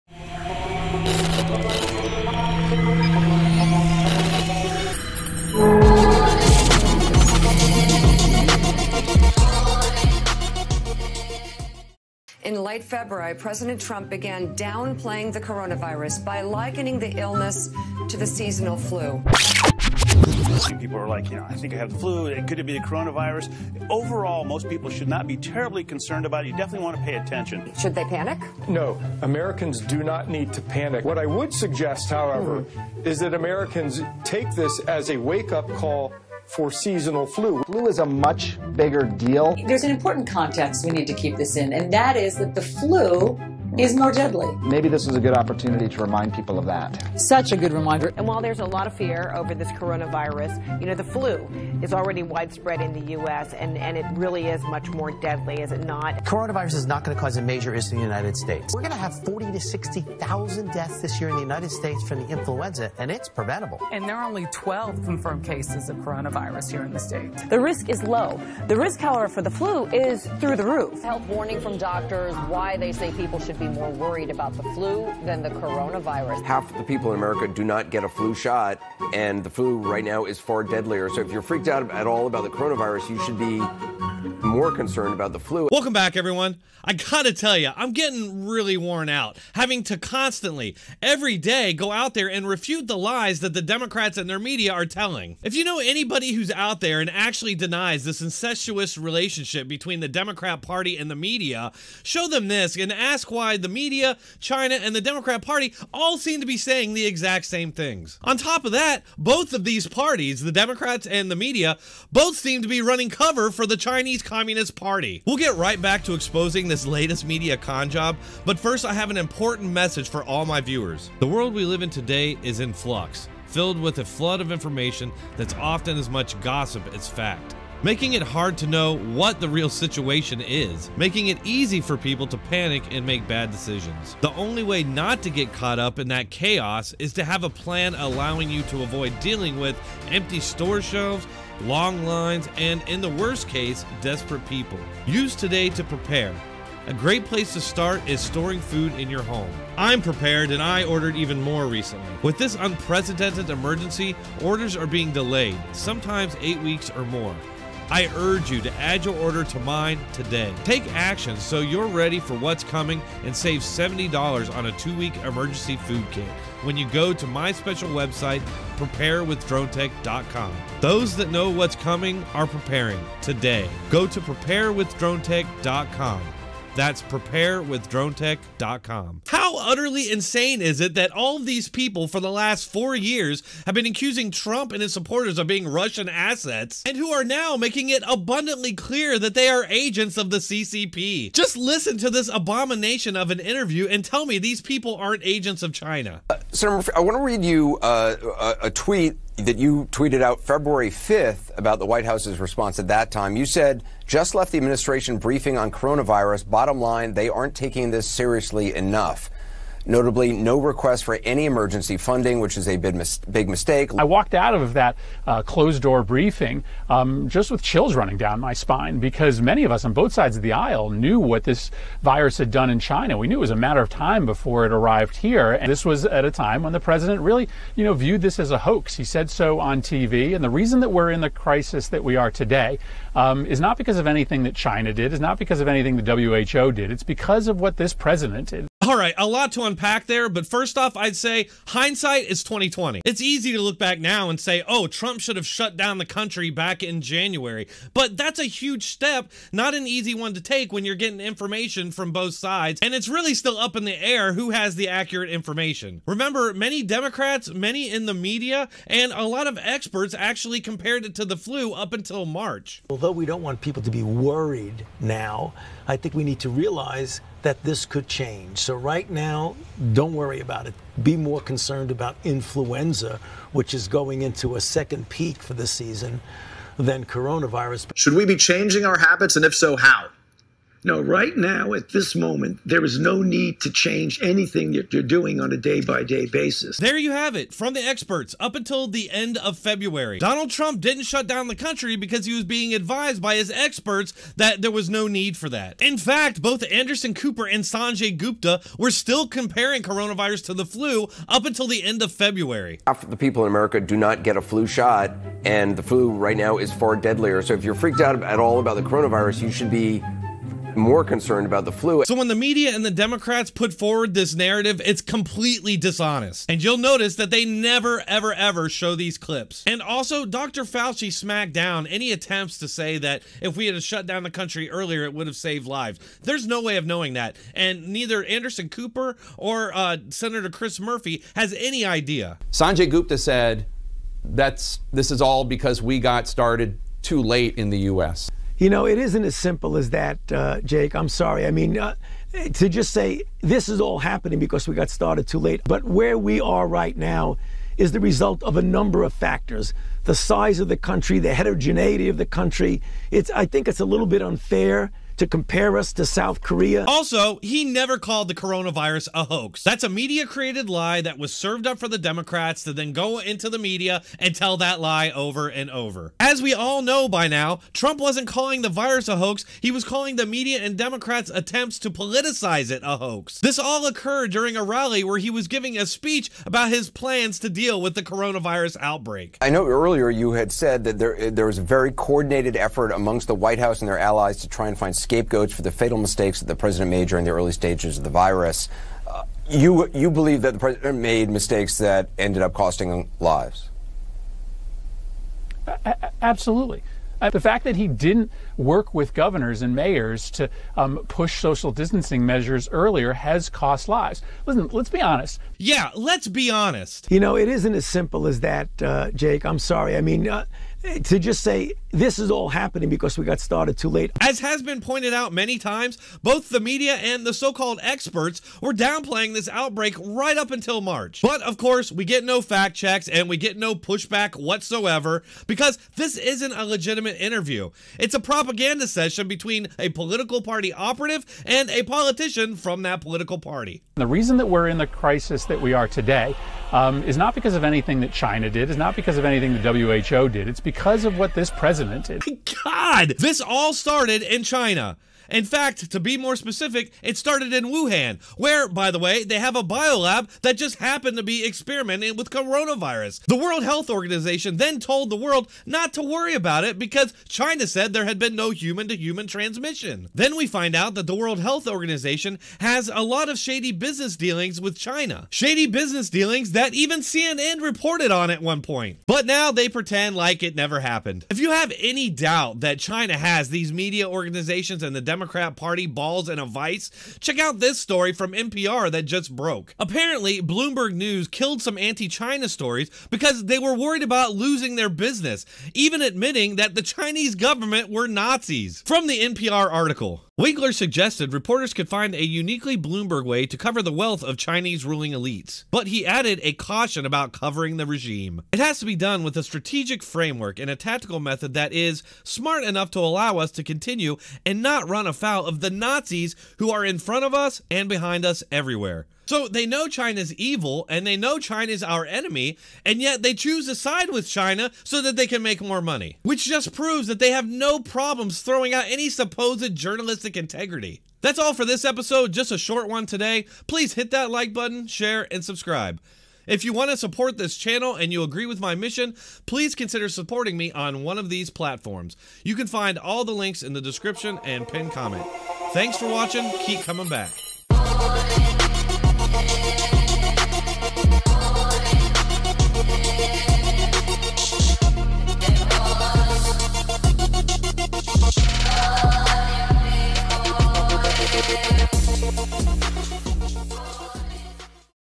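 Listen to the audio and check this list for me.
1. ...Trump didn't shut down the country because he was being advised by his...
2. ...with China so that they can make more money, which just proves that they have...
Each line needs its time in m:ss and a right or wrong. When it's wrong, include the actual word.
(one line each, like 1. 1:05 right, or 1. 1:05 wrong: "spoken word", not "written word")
1. 4:50 right
2. 8:34 right.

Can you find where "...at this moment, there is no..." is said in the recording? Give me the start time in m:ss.
4:41.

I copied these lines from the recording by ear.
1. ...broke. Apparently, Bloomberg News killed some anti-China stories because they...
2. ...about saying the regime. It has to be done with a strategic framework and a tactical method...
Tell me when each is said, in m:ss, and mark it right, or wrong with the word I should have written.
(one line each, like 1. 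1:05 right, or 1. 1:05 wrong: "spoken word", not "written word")
1. 7:59 right
2. 8:17 wrong: "covering", not "saying".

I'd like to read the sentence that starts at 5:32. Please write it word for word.
Sanjay Gupta said, that's this is all because we got started too late in the US.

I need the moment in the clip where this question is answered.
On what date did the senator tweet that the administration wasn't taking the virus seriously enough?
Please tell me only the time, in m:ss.
3:20.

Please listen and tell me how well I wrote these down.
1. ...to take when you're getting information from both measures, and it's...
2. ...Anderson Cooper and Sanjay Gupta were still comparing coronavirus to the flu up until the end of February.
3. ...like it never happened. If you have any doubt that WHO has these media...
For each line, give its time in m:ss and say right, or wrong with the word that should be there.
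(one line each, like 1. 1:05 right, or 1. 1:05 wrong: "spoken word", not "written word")
1. 4:10 wrong: "sides", not "measures"
2. 4:56 right
3. 7:50 wrong: "China", not "WHO".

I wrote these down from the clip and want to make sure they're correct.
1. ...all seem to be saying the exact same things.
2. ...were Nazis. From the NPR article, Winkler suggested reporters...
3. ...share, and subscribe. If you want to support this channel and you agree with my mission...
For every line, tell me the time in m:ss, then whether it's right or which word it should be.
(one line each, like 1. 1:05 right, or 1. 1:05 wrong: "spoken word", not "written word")
1. 1:45 right
2. 8:07 right
3. 8:44 right.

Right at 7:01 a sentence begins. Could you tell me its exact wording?
But of course, we get no fact checks and we get no pushback whatsoever because this isn't a legitimate interview.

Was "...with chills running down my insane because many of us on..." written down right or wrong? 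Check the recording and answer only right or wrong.
wrong.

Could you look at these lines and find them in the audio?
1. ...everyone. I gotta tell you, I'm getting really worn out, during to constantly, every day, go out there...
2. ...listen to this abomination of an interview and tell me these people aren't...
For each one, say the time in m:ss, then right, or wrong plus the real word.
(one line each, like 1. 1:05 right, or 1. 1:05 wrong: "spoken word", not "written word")
1. 1:26 wrong: "having", not "during"
2. 3:11 right.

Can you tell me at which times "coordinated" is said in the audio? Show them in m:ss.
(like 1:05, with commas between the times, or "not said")
6:21.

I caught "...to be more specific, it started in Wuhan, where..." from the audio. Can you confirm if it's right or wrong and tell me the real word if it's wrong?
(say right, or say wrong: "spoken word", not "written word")
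right.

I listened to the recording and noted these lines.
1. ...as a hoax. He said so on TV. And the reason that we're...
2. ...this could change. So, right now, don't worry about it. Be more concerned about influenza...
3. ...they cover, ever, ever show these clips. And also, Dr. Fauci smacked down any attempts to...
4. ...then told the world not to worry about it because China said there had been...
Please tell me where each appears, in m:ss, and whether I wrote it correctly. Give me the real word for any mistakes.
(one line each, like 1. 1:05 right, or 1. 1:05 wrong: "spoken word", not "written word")
1. 3:48 right
2. 4:27 right
3. 5:17 wrong: "never", not "cover"
4. 7:34 right.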